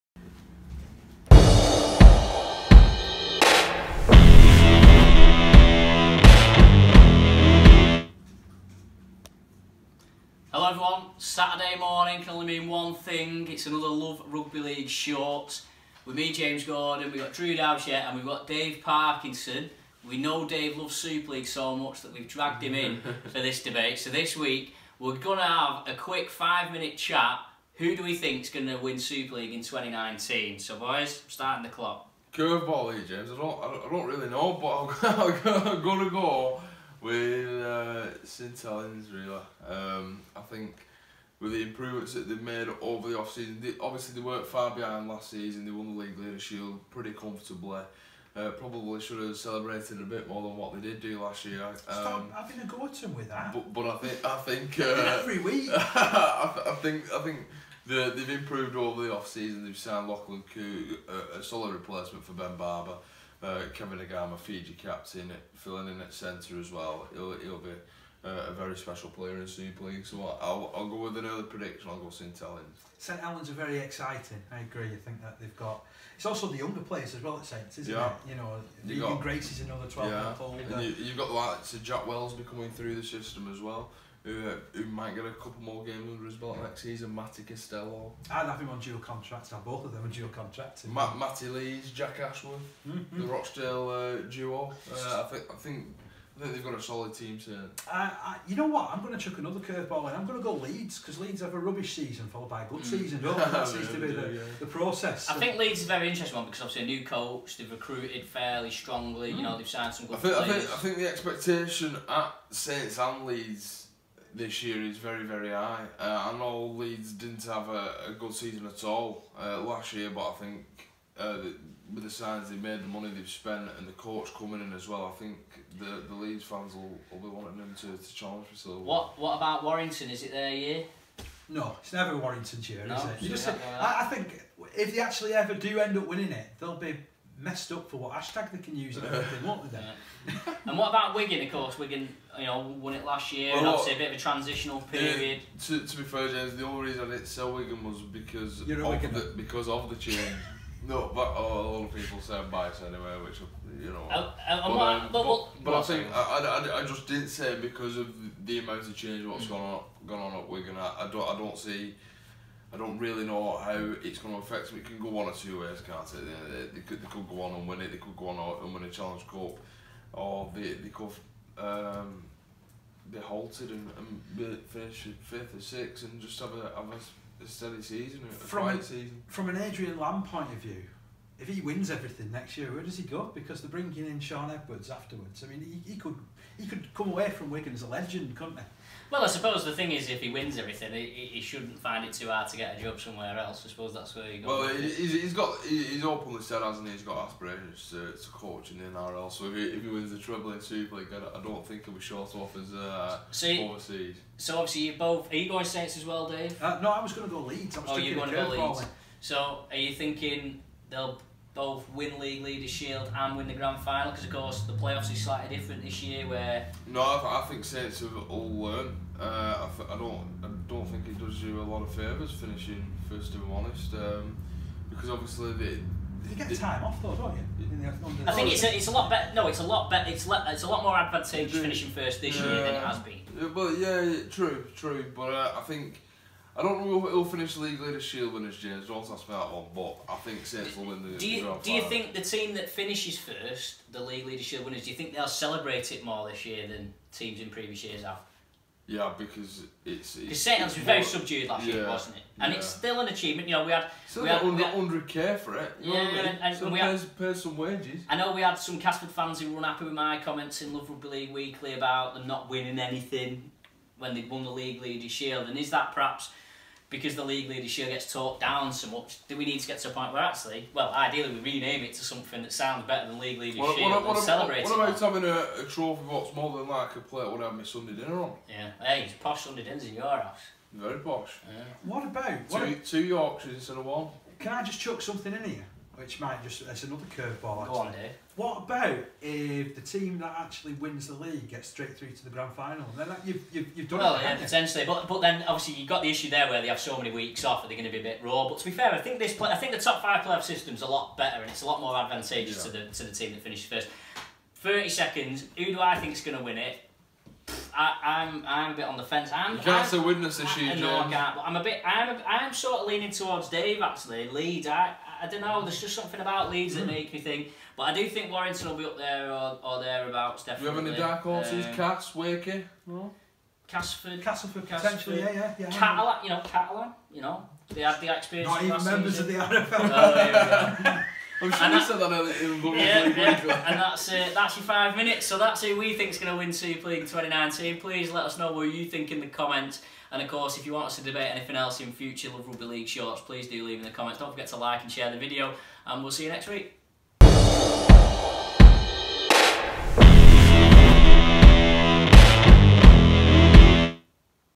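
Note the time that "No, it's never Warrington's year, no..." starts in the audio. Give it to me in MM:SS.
02:11.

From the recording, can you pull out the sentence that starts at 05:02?
to the to the team that finishes first.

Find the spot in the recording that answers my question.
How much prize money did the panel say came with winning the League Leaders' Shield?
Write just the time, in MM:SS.
04:14.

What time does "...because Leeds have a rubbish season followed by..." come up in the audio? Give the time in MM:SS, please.
01:40.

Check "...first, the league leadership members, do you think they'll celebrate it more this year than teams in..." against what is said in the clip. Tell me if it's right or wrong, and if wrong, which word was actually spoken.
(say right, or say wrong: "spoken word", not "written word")
wrong: "winners", not "members".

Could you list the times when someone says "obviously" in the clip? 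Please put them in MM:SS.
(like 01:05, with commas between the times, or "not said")
00:43, 01:46, 02:23, 03:24, 03:45, 04:55.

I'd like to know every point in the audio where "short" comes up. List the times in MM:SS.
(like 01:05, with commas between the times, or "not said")
00:14, 03:22, 05:42.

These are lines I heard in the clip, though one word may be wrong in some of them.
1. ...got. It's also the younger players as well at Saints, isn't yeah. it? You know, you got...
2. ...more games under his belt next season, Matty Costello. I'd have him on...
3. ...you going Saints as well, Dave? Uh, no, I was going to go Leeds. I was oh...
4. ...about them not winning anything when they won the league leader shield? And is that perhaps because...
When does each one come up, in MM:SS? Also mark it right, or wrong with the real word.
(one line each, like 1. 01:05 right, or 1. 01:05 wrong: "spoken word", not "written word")
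1. 01:15 right
2. 01:25 right
3. 03:25 right
4. 04:21 right.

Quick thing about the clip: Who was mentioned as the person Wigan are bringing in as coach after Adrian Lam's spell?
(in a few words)
Shaun Edwards.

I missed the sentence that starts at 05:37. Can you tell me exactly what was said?
Please let us know what you think in the comments.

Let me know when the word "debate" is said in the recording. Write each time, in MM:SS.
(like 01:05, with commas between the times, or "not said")
00:23, 05:41.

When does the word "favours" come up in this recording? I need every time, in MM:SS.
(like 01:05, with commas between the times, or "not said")
03:41.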